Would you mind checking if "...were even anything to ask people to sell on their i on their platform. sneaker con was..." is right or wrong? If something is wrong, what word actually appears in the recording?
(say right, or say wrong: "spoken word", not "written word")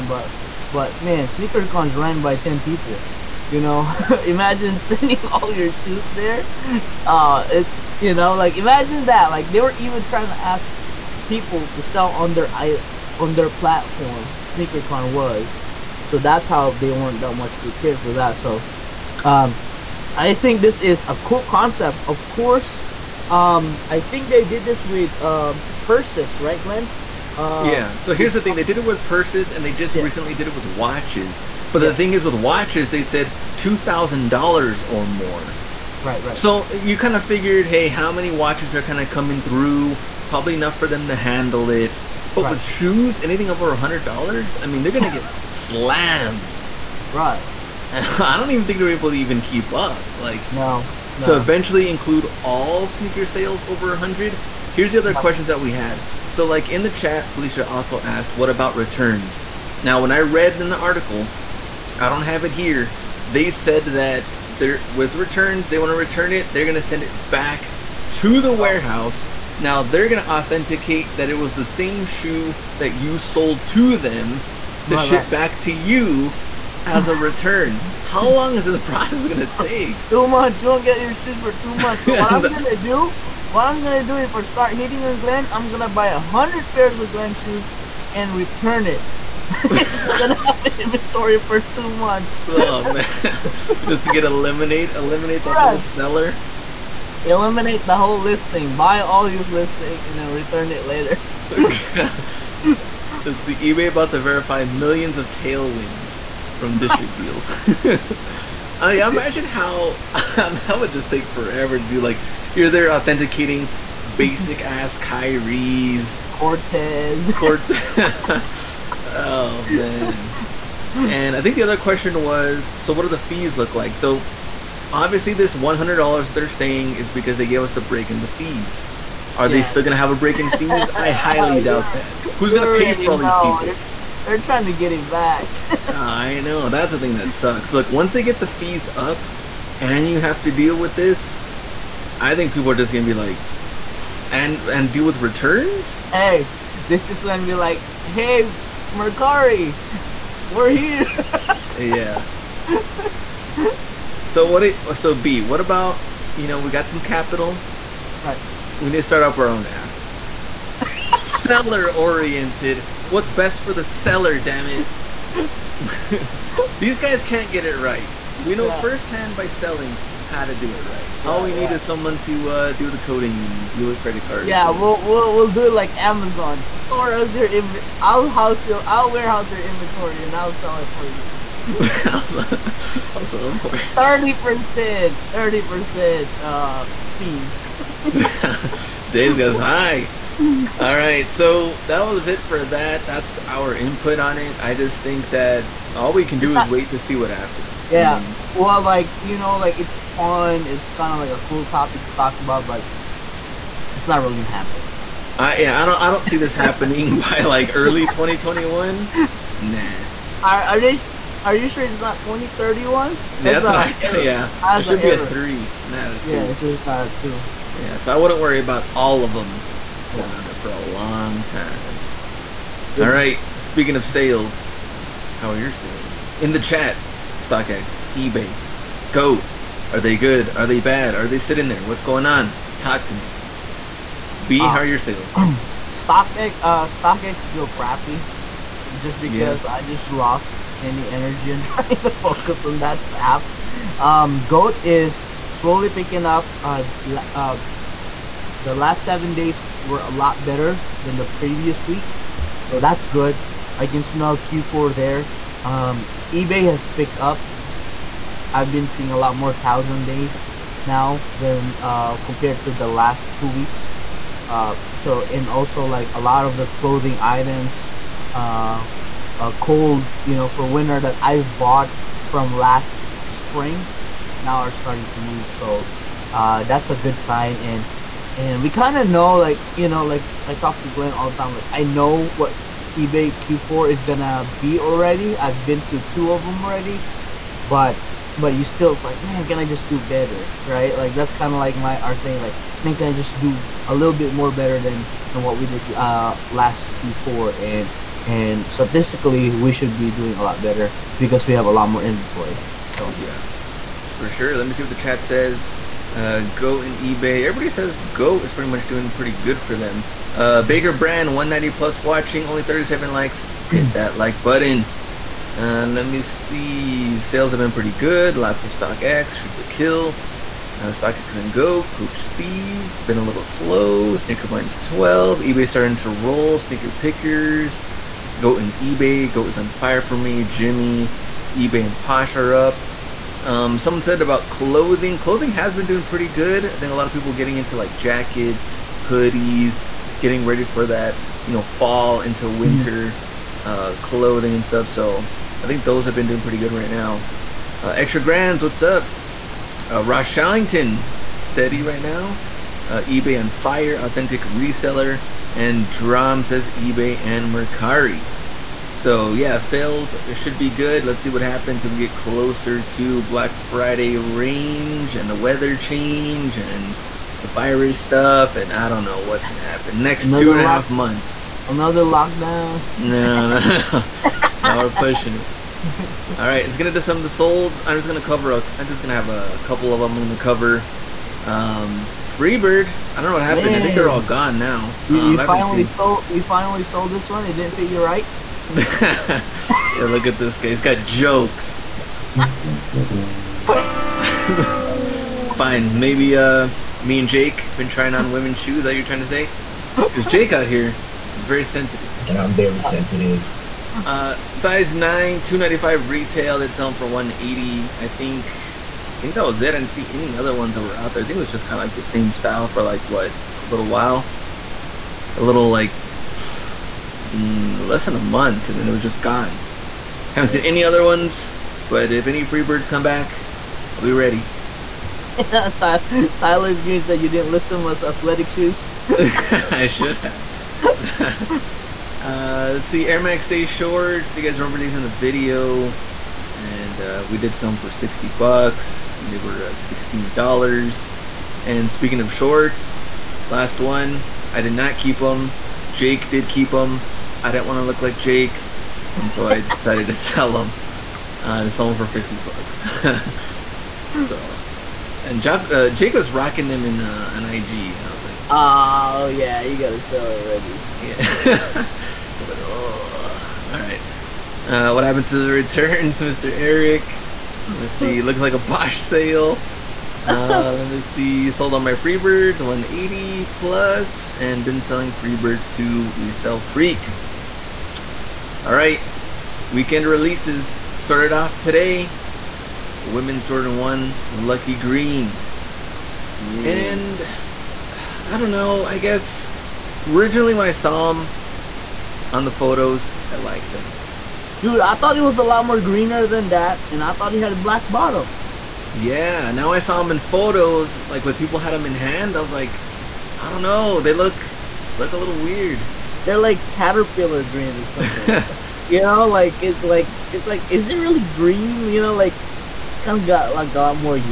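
wrong: "trying", not "anything".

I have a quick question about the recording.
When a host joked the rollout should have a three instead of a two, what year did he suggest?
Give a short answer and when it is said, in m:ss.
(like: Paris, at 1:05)
2031, at 3:32.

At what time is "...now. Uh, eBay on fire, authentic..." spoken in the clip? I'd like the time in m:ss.
5:52.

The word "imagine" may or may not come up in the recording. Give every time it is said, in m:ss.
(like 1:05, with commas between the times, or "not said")
0:04, 0:08, 1:49.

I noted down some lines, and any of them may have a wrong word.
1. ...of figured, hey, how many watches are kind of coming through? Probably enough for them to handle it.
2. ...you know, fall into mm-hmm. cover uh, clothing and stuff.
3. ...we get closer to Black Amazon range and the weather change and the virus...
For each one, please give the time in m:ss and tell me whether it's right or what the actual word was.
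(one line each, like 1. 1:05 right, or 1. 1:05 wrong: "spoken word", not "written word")
1. 0:37 right
2. 5:41 wrong: "winter", not "cover"
3. 6:01 wrong: "Friday", not "Amazon".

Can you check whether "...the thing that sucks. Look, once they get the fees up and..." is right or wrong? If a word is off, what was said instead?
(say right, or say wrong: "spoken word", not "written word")
right.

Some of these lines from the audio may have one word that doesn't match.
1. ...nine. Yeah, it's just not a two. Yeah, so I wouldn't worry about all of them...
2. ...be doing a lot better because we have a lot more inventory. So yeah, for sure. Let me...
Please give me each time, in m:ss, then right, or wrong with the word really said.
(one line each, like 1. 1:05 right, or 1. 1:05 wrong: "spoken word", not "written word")
1. 3:36 wrong: "two", not "nine"
2. 4:59 right.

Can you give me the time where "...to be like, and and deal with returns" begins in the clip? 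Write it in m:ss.
2:23.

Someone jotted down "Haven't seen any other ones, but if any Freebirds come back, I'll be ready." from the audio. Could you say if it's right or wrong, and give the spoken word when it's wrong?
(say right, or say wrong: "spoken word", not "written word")
right.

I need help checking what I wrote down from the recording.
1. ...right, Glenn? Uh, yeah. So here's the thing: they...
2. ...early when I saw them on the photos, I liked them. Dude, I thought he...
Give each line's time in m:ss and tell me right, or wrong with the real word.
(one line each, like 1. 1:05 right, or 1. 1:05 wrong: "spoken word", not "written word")
1. 0:26 right
2. 8:10 wrong: "originally", not "early".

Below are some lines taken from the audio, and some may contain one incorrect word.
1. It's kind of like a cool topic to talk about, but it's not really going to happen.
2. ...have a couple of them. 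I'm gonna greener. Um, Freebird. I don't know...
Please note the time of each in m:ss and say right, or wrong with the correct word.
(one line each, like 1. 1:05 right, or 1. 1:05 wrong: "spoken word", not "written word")
1. 3:20 right
2. 6:19 wrong: "cover", not "greener".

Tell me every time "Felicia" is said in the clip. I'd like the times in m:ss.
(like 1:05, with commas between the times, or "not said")
0:57.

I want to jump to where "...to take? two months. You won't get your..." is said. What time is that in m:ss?
1:19.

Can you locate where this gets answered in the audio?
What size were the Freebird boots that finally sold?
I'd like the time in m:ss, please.
6:44.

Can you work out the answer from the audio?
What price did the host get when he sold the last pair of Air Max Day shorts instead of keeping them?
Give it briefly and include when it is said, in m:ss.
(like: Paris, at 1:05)
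$50, at 7:32.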